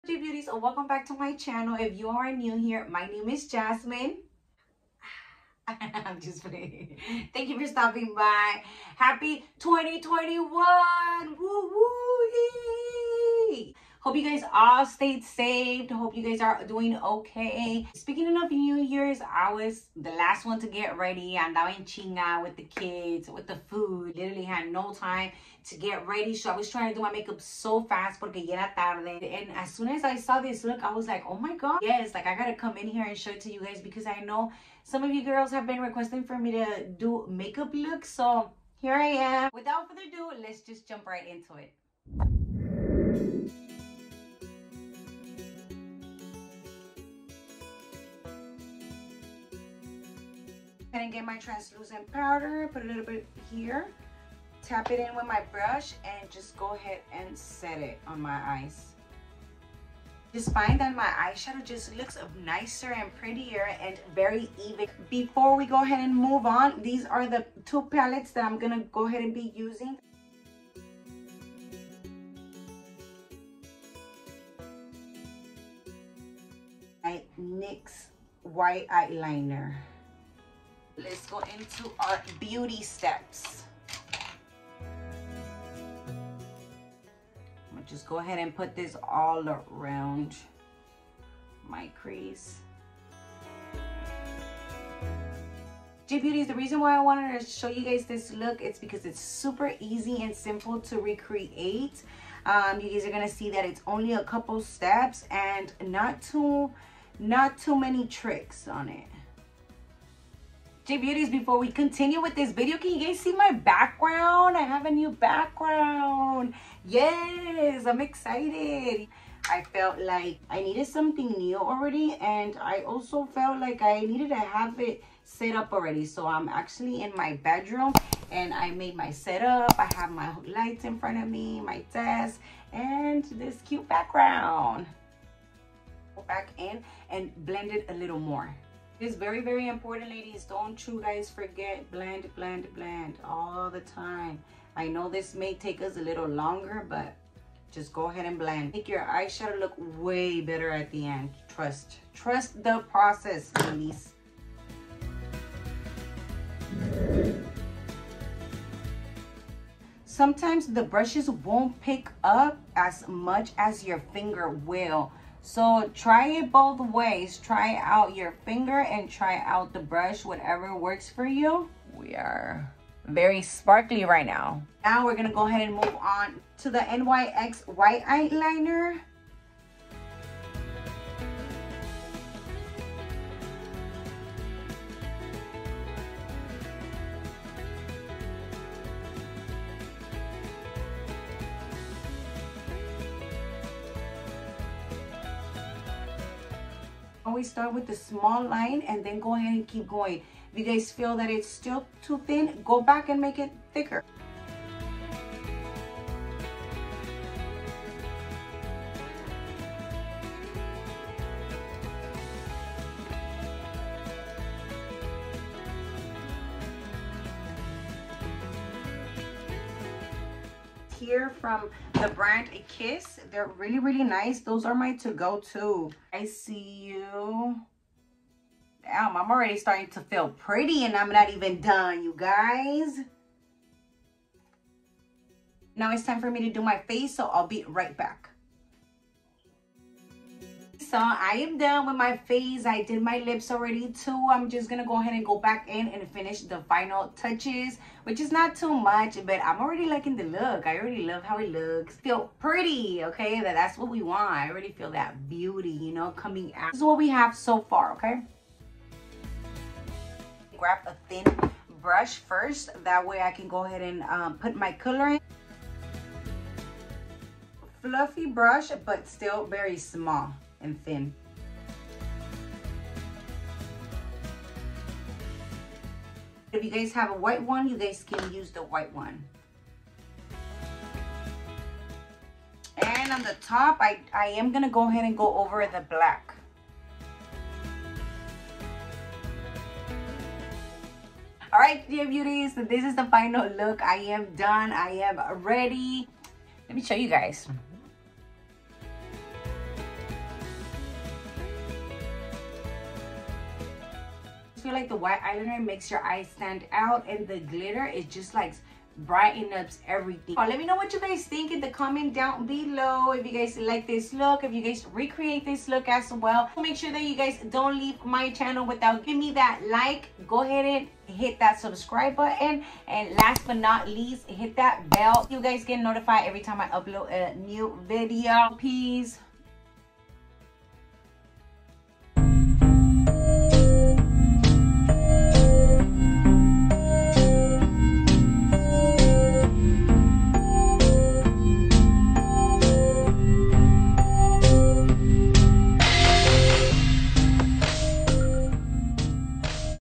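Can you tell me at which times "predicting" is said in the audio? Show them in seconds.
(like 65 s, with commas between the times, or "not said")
not said.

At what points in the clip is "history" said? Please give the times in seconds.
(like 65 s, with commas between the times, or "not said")
not said.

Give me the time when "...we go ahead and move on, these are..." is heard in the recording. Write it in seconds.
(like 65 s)
65 s.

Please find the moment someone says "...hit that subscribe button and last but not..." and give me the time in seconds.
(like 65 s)
321 s.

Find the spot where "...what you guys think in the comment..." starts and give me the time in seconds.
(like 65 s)
310 s.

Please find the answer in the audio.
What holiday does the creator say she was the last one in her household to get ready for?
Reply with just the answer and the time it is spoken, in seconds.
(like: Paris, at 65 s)
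New Year's, at 18 s.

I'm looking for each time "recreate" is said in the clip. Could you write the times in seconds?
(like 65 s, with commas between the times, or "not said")
100 s, 314 s.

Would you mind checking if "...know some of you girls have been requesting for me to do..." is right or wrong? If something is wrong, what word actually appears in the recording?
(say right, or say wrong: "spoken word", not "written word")
right.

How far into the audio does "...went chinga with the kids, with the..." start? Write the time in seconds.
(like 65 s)
21 s.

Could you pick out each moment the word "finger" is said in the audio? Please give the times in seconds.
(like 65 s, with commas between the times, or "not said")
164 s, 168 s.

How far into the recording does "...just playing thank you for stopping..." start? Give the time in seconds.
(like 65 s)
6 s.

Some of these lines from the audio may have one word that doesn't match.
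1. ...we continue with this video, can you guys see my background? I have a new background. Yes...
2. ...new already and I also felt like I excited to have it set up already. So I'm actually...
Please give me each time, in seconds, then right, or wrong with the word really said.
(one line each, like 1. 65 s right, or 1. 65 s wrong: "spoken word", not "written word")
1. 111 s right
2. 121 s wrong: "needed", not "excited".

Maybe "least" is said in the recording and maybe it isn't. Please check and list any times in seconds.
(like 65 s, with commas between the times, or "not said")
323 s.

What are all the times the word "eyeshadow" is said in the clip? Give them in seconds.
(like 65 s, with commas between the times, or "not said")
61 s, 149 s.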